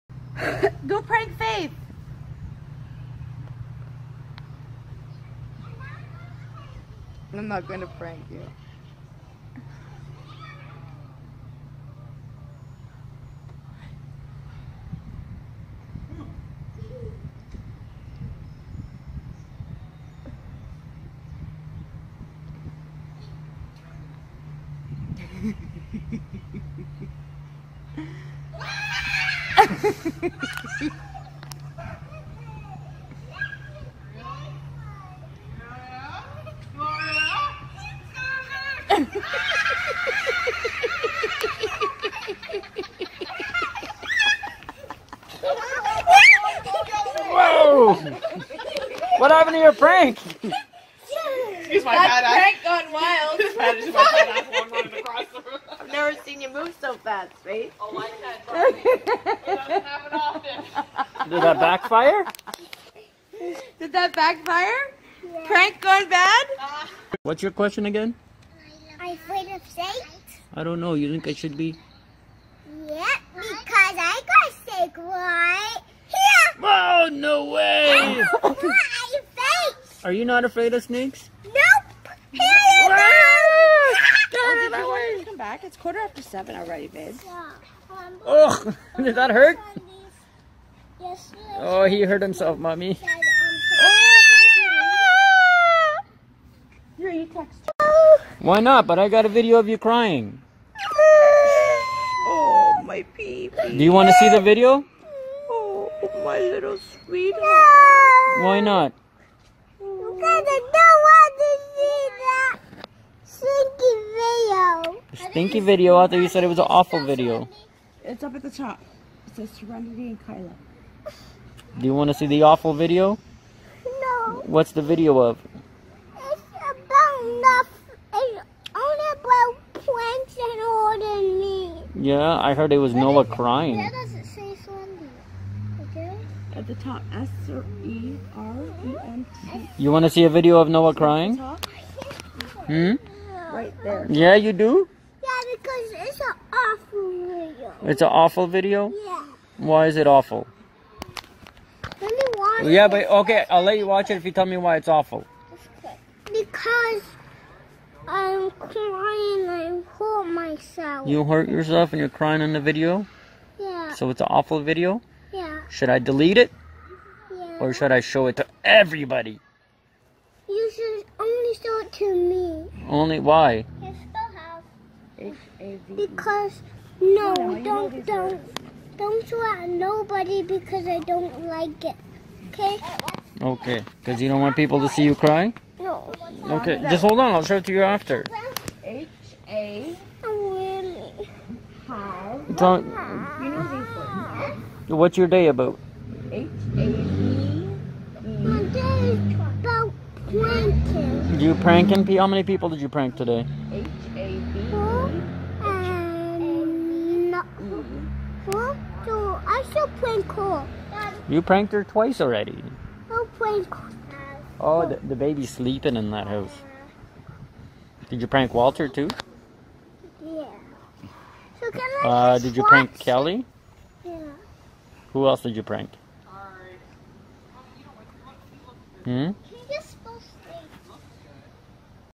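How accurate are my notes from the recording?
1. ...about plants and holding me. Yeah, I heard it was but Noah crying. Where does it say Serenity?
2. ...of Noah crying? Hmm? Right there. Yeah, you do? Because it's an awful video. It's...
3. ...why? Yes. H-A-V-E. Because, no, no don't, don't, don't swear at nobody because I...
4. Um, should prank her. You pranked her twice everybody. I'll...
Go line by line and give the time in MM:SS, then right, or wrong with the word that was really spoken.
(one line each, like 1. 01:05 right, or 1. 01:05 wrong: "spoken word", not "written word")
1. 02:09 right
2. 02:20 right
3. 02:53 right
4. 03:25 wrong: "already", not "everybody".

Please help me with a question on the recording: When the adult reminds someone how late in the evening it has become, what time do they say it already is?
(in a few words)
7:15.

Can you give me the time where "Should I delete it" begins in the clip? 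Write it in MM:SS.
02:45.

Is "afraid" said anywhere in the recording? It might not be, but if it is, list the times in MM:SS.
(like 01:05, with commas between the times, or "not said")
01:09, 01:20.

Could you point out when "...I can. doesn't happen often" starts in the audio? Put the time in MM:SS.
00:58.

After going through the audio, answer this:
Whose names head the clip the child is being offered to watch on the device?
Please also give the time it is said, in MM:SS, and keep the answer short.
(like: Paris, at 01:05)
Serenity and Kyla, at 01:59.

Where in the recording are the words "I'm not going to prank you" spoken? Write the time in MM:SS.
00:07.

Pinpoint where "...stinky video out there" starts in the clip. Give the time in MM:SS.
01:55.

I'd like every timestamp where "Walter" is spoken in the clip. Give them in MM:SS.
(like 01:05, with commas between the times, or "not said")
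03:38.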